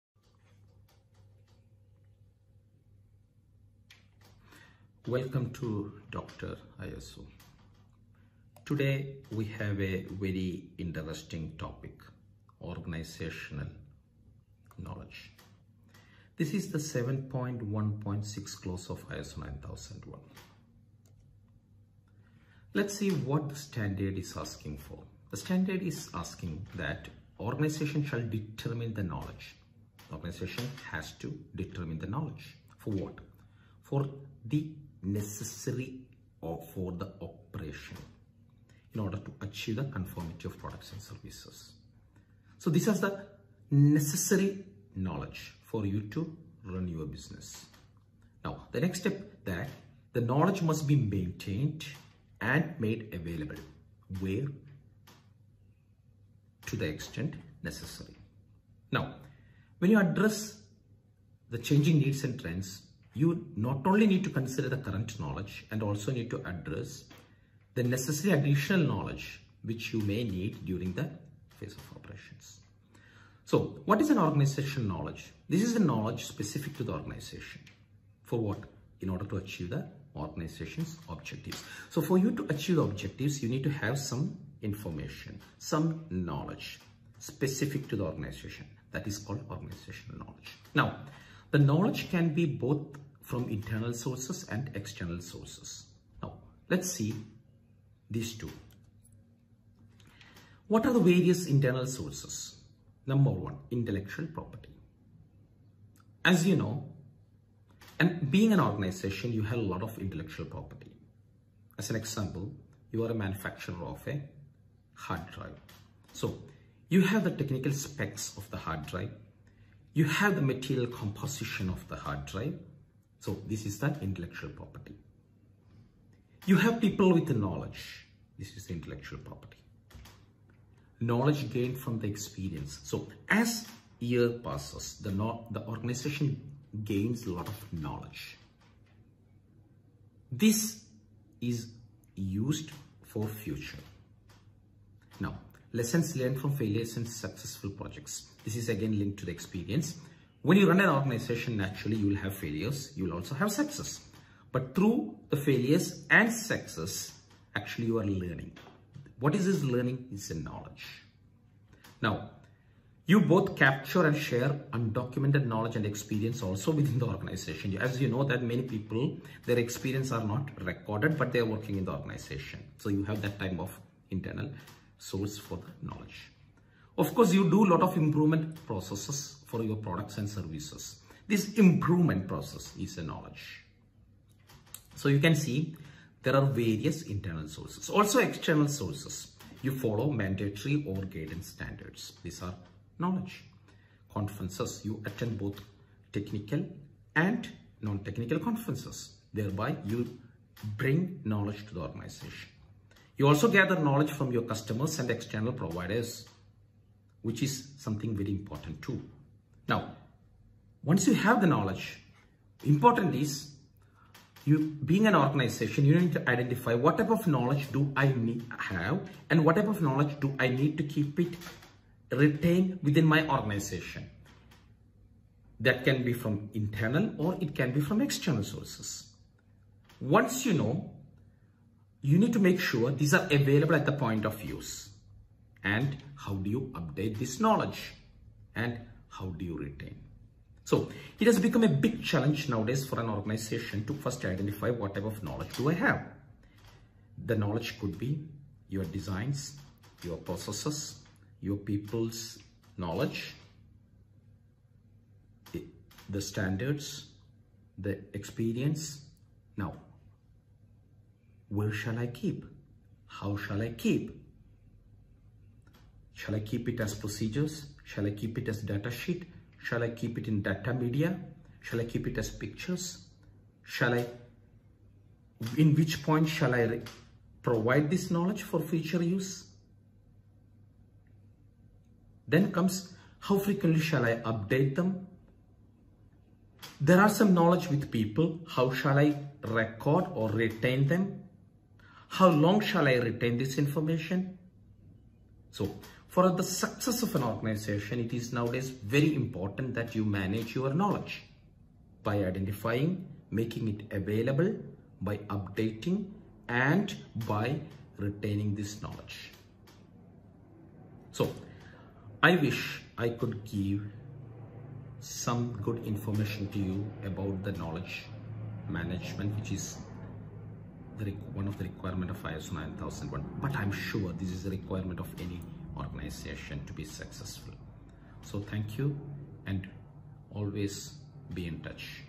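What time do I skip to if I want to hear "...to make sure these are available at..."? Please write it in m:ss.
3:52.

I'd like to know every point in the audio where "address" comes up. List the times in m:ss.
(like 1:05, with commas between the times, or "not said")
0:59, 1:06.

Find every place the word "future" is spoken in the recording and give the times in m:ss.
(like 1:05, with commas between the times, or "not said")
2:23, 4:38.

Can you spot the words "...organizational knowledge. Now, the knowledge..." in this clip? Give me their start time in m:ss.
1:29.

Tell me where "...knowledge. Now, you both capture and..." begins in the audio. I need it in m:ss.
2:40.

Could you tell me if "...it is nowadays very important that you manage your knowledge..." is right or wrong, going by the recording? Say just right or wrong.
right.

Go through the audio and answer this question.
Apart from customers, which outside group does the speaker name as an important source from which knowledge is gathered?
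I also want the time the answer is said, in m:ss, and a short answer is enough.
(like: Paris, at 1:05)
External providers, at 3:25.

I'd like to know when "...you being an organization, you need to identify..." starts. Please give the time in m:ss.
3:34.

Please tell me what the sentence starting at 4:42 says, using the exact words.
Then comes, how frequently shall I update them?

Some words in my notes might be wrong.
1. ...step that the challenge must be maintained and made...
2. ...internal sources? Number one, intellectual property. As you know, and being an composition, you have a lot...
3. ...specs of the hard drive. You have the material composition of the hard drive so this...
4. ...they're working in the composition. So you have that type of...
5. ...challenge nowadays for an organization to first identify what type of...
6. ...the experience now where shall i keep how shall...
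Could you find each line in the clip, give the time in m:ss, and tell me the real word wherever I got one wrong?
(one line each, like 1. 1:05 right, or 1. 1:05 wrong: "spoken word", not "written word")
1. 0:49 wrong: "knowledge", not "challenge"
2. 1:41 wrong: "organization", not "composition"
3. 1:57 right
4. 2:51 wrong: "organization", not "composition"
5. 4:02 right
6. 4:17 right.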